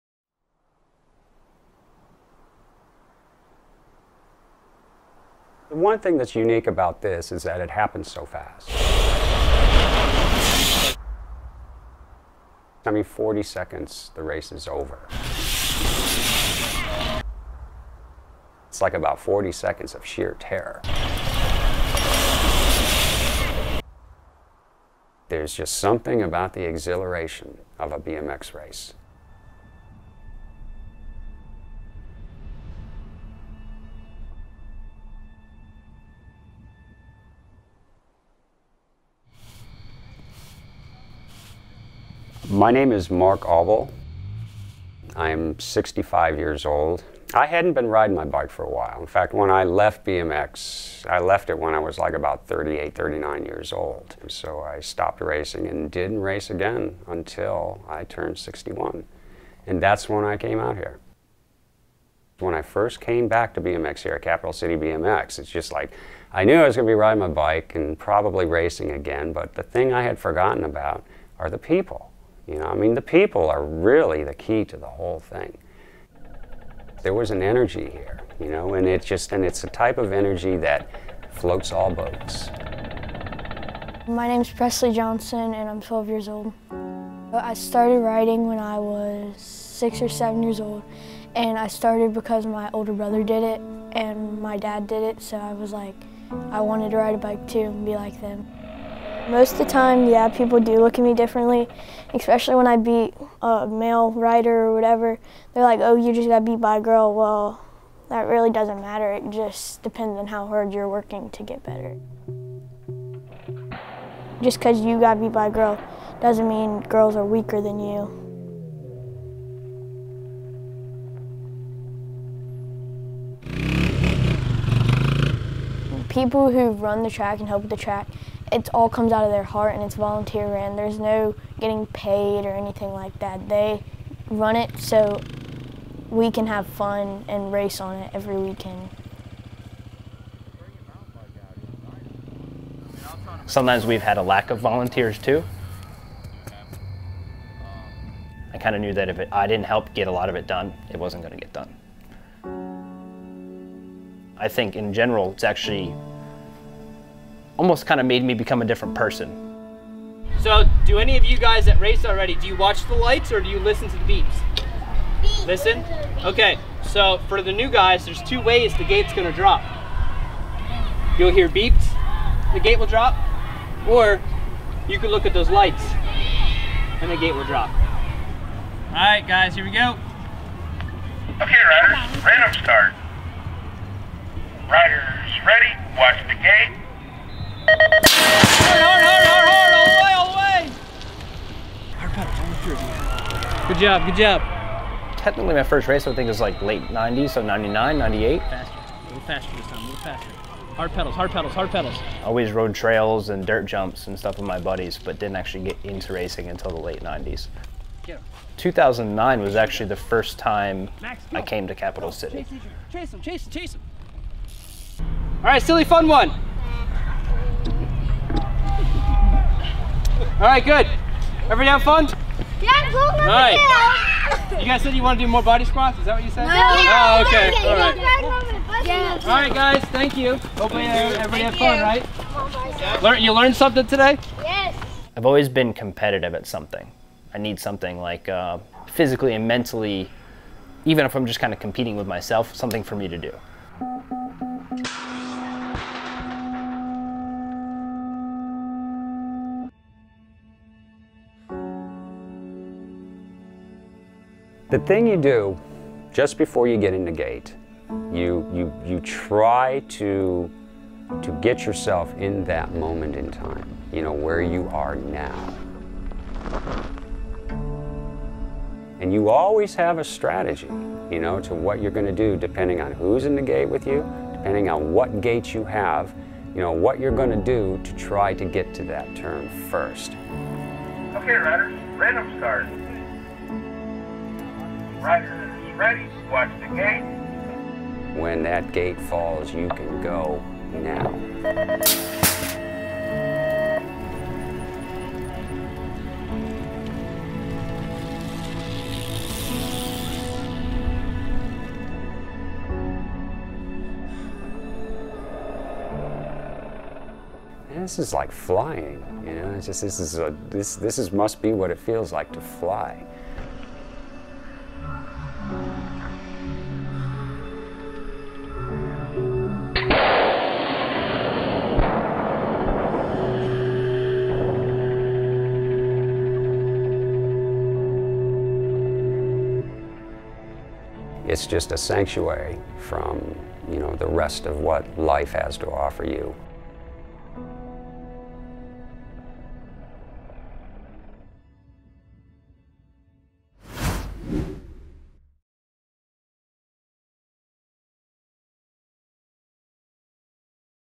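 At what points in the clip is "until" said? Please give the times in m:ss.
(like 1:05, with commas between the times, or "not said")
0:57, 3:26.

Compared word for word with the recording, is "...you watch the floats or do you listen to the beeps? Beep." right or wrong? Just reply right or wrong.
wrong.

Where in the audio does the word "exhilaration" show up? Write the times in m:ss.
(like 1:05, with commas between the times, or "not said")
0:26.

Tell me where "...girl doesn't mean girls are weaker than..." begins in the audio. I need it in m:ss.
1:55.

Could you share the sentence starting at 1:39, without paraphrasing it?
Most of the time, yeah, people do look at me differently, especially when I beat a male rider or whatever.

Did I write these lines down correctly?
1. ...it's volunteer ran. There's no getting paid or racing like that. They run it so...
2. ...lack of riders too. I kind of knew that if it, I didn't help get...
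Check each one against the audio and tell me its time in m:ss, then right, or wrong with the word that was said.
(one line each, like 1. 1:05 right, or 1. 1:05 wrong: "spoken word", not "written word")
1. 2:09 wrong: "anything", not "racing"
2. 2:24 wrong: "volunteers", not "riders".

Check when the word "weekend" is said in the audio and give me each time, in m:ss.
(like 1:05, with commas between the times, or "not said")
2:18.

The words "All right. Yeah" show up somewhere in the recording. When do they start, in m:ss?
3:47.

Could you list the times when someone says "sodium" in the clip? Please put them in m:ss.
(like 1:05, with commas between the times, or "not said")
not said.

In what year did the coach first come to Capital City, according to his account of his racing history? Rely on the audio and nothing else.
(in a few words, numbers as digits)
2009.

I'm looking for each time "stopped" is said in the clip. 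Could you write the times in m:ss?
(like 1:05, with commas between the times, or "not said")
0:54.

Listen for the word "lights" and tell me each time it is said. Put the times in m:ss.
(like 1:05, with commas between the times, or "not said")
2:42, 2:55.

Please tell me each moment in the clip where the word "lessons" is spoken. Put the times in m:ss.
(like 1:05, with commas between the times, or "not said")
not said.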